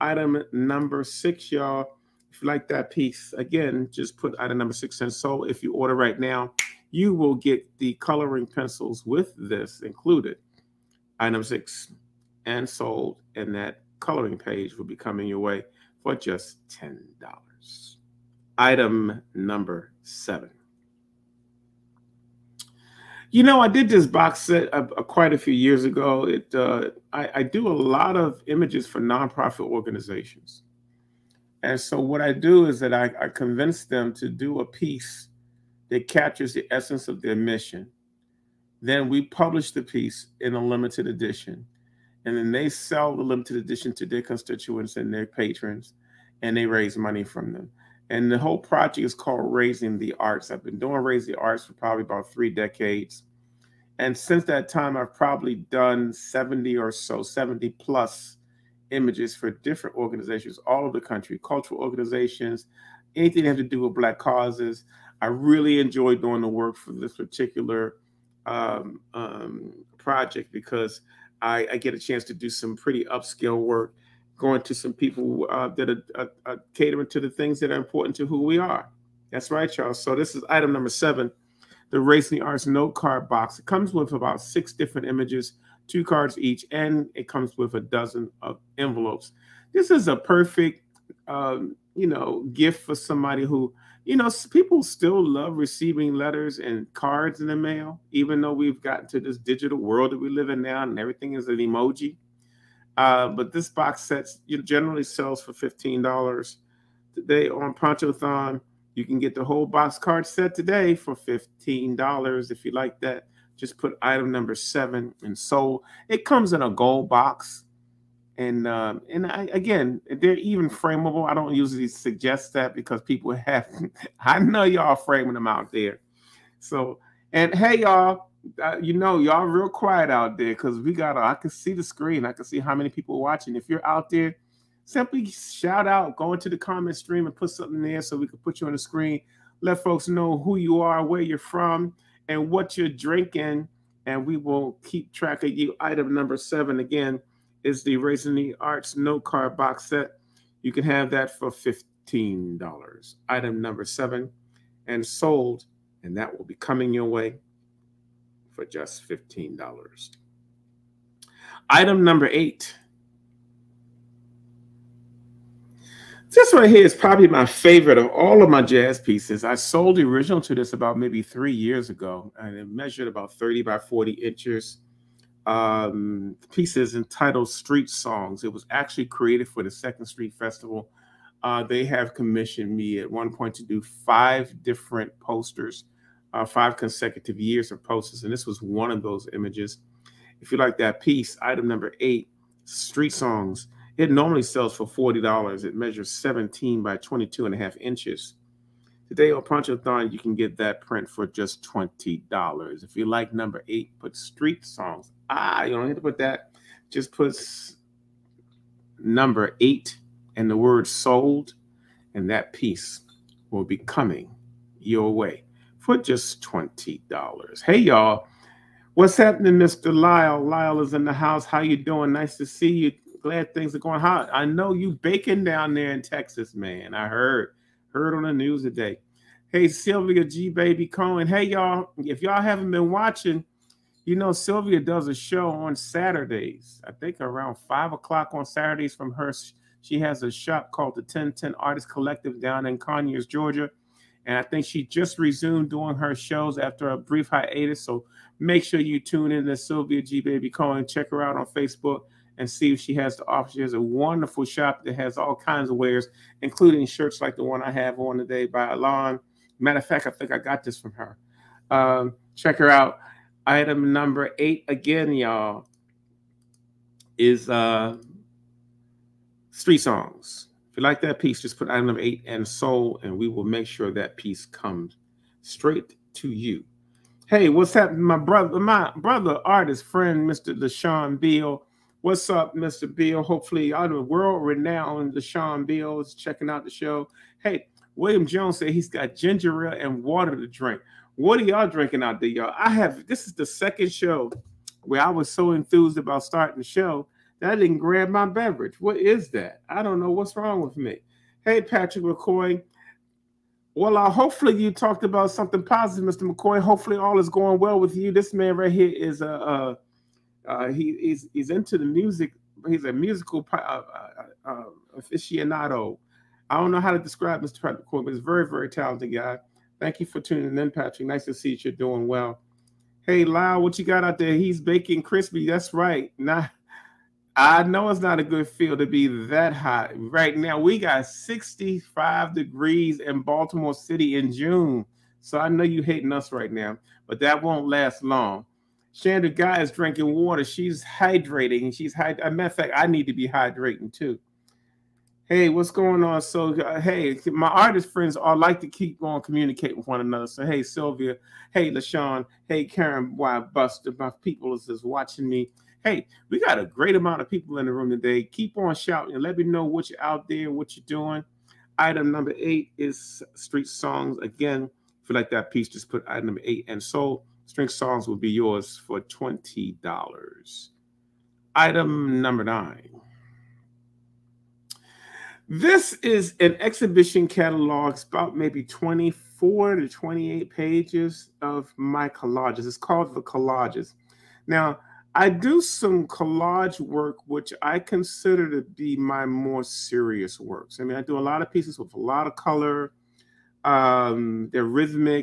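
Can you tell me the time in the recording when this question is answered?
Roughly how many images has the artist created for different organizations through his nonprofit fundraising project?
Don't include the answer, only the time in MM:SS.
00:57.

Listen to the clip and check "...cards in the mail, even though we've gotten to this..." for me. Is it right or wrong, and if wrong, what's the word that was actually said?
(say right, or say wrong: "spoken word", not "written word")
right.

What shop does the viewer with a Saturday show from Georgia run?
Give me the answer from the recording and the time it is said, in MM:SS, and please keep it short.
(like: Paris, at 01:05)
1010 Artist Collective, at 04:01.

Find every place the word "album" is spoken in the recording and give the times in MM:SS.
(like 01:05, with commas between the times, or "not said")
not said.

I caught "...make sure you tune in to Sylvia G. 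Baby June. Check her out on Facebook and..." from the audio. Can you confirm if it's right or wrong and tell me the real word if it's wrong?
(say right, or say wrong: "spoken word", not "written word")
wrong: "Cohen", not "June".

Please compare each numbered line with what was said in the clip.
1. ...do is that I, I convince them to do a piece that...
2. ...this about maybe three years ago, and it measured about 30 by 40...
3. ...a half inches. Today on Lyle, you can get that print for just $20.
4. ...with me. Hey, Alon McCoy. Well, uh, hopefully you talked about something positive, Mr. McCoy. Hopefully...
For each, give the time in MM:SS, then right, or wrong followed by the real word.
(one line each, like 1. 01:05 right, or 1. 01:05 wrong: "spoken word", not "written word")
1. 00:32 right
2. 02:50 right
3. 03:17 wrong: "Ponchothon", not "Lyle"
4. 05:00 wrong: "Patrick", not "Alon".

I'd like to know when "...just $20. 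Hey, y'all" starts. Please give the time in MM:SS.
03:35.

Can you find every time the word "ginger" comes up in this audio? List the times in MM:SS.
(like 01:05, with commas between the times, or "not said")
04:49.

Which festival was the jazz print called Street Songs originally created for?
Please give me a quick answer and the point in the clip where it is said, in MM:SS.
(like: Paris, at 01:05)
Second Street Festival, at 02:59.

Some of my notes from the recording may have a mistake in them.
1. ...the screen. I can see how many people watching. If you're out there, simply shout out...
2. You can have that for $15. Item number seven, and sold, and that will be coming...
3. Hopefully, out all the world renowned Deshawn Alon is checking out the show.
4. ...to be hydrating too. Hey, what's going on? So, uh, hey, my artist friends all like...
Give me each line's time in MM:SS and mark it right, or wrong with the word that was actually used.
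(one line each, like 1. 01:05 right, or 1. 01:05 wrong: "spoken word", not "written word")
1. 02:11 right
2. 02:30 right
3. 04:43 wrong: "Beal", not "Alon"
4. 05:43 right.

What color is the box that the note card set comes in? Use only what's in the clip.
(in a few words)
Gold.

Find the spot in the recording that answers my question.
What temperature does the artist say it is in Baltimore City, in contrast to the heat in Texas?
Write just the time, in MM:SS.
05:31.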